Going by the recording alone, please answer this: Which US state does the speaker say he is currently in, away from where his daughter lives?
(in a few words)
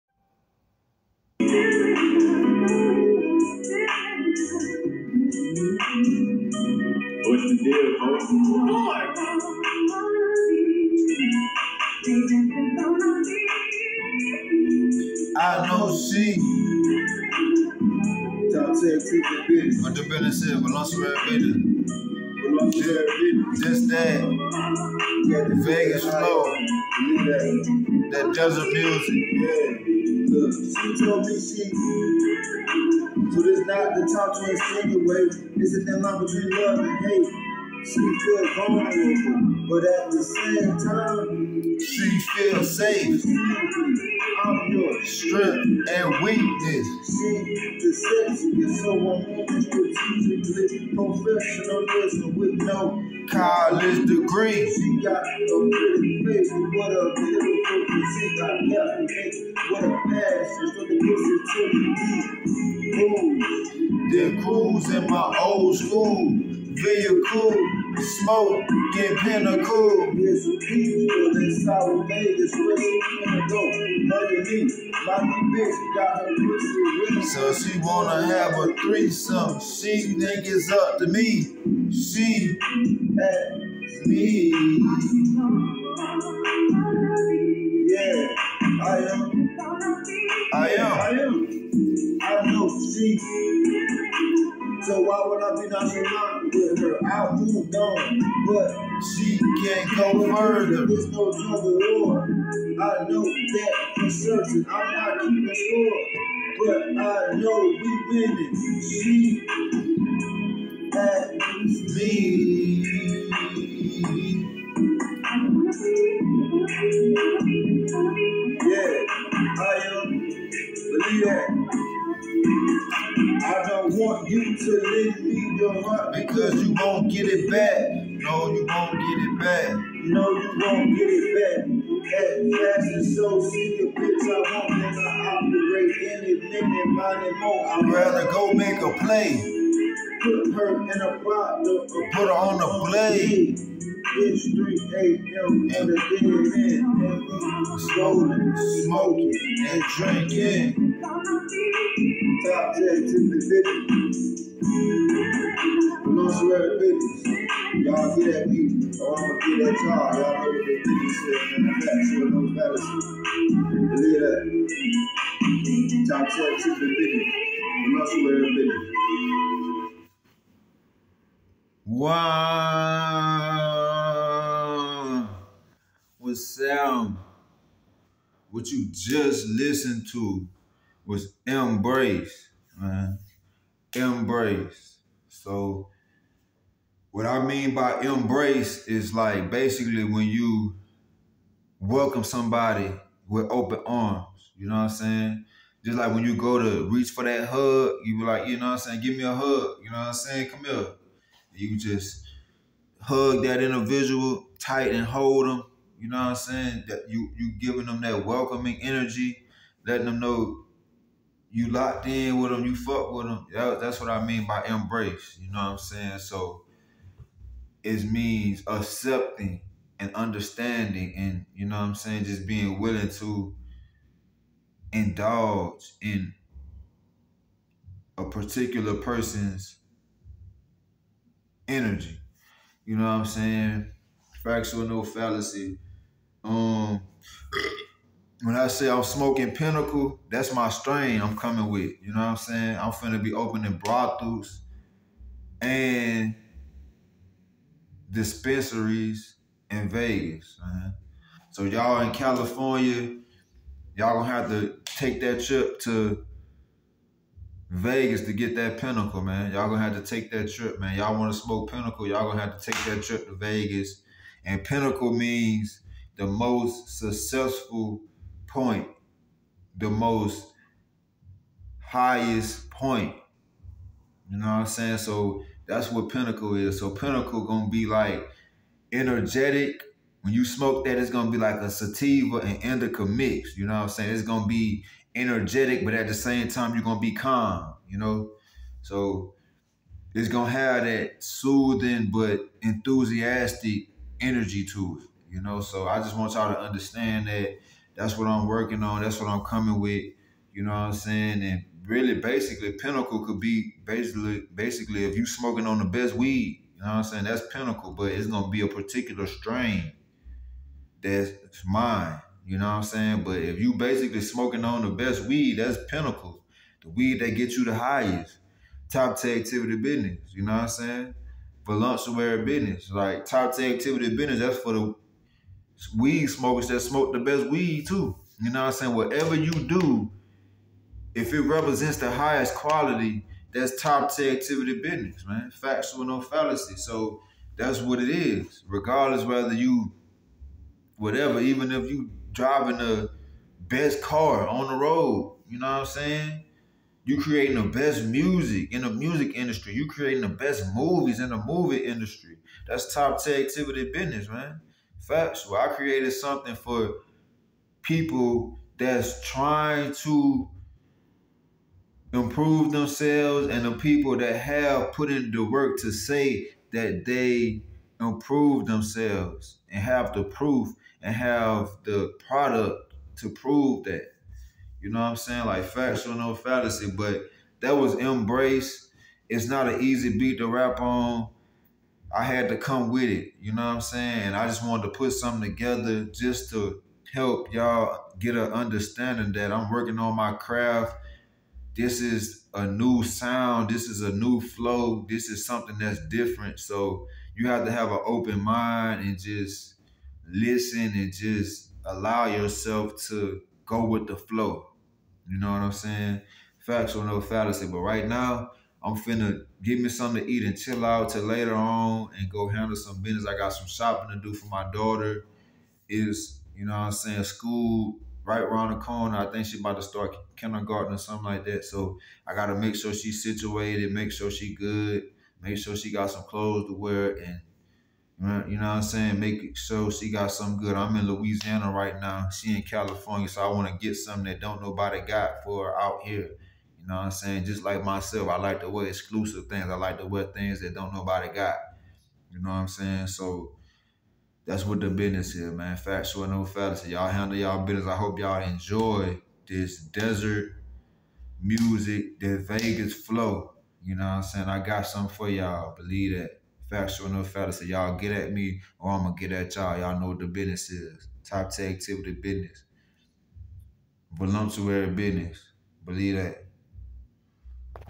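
Louisiana.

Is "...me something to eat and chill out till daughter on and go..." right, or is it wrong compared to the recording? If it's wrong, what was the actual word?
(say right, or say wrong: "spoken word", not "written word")
wrong: "later", not "daughter".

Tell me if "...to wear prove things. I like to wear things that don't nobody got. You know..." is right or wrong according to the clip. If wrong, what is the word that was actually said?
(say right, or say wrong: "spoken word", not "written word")
wrong: "exclusive", not "prove".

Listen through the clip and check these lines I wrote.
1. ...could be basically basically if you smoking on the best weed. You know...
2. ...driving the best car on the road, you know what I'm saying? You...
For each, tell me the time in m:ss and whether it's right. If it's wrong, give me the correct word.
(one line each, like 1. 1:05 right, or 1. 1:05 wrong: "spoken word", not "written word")
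1. 5:03 right
2. 5:42 right.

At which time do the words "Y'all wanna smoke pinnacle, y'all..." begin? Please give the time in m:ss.
4:20.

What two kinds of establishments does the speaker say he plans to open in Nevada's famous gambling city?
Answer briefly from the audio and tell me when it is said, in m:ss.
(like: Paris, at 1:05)
brothels and dispensaries, at 4:03.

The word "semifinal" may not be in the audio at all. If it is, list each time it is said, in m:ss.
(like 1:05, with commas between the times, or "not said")
not said.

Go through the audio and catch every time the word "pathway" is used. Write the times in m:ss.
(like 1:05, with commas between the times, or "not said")
not said.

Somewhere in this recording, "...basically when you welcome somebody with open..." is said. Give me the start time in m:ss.
3:09.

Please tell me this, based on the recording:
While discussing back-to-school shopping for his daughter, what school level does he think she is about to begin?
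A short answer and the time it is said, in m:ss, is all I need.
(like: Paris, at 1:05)
kindergarten, at 7:00.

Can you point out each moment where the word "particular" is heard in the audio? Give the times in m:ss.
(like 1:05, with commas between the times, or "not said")
3:48, 5:08.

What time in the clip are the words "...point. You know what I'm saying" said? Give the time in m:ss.
4:32.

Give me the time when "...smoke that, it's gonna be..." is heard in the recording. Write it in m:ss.
4:40.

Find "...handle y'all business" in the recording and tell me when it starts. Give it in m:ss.
7:27.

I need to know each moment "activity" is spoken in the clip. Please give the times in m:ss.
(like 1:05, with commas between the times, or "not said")
5:19, 5:23, 5:34, 5:53, 7:41.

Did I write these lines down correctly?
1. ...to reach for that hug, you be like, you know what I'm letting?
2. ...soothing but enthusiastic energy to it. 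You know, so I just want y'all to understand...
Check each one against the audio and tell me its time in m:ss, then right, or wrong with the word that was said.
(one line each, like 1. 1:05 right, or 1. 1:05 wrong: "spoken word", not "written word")
1. 3:16 wrong: "saying", not "letting"
2. 4:51 right.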